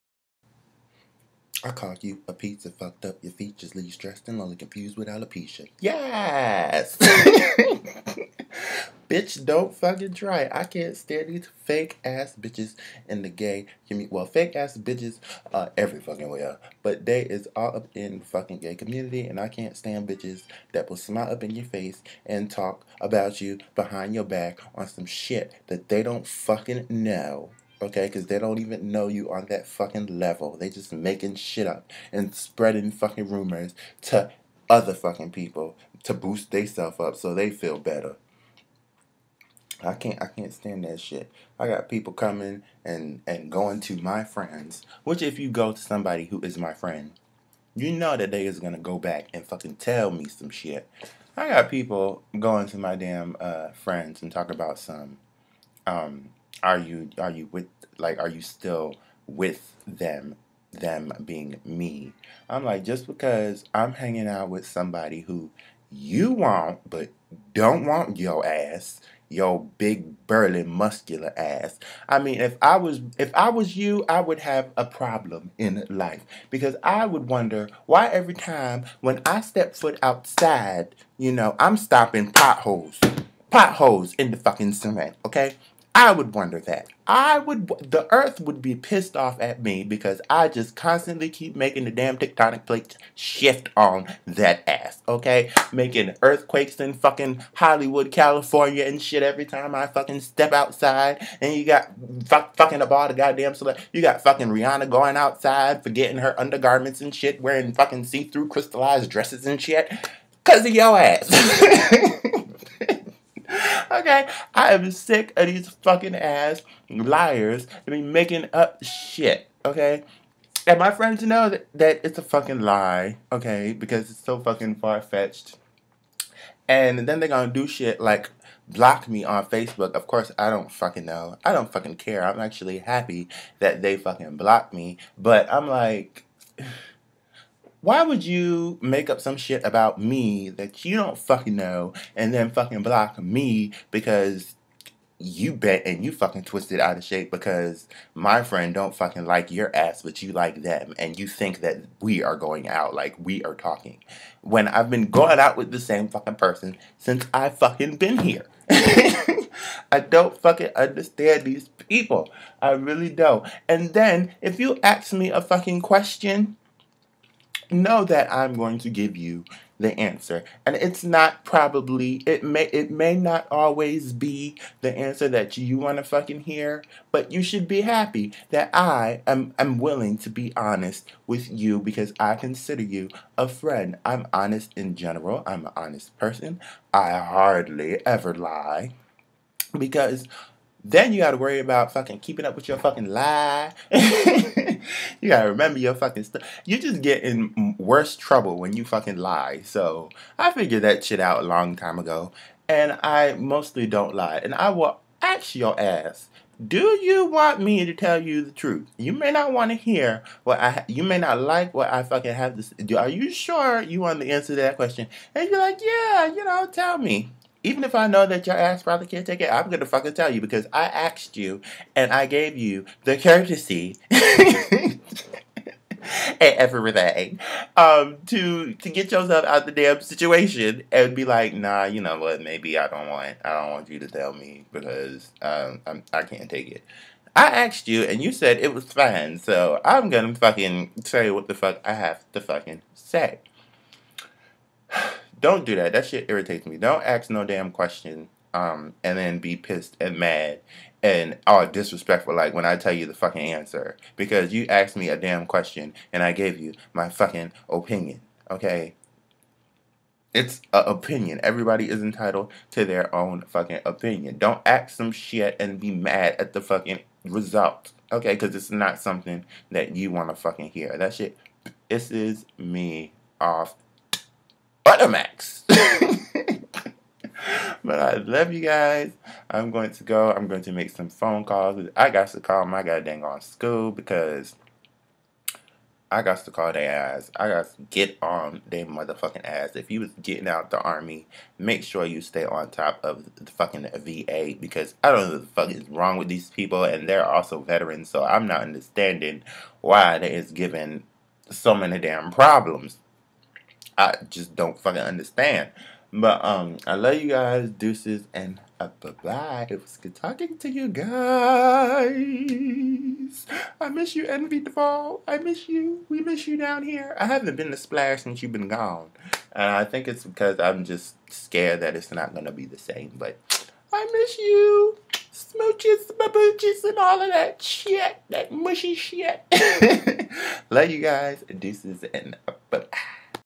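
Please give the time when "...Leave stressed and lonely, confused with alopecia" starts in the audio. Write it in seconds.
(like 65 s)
3 s.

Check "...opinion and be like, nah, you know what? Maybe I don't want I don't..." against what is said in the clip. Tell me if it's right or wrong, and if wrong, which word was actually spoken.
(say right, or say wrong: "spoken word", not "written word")
wrong: "situation", not "opinion".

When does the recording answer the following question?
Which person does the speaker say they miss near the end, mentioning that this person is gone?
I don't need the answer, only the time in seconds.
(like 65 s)
314 s.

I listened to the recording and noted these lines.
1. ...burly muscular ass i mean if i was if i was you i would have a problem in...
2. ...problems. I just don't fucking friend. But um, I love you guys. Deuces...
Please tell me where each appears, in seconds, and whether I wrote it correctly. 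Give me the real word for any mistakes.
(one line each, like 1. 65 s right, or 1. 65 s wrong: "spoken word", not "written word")
1. 70 s right
2. 302 s wrong: "understand", not "friend".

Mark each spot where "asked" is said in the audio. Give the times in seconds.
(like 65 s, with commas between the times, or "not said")
220 s, 237 s, 254 s.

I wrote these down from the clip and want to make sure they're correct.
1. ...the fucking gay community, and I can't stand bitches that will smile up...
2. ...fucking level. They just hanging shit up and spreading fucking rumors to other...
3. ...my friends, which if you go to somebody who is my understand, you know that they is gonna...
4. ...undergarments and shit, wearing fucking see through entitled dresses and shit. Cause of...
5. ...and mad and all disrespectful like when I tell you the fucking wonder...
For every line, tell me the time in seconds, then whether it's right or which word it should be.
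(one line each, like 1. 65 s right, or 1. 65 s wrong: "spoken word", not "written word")
1. 18 s right
2. 29 s wrong: "making", not "hanging"
3. 43 s wrong: "friend", not "understand"
4. 106 s wrong: "crystallized", not "entitled"
5. 249 s wrong: "answer", not "wonder".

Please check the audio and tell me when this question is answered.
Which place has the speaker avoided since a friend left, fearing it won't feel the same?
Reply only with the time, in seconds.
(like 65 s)
317 s.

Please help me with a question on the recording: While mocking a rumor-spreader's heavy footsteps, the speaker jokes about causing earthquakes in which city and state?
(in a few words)
Hollywood, California.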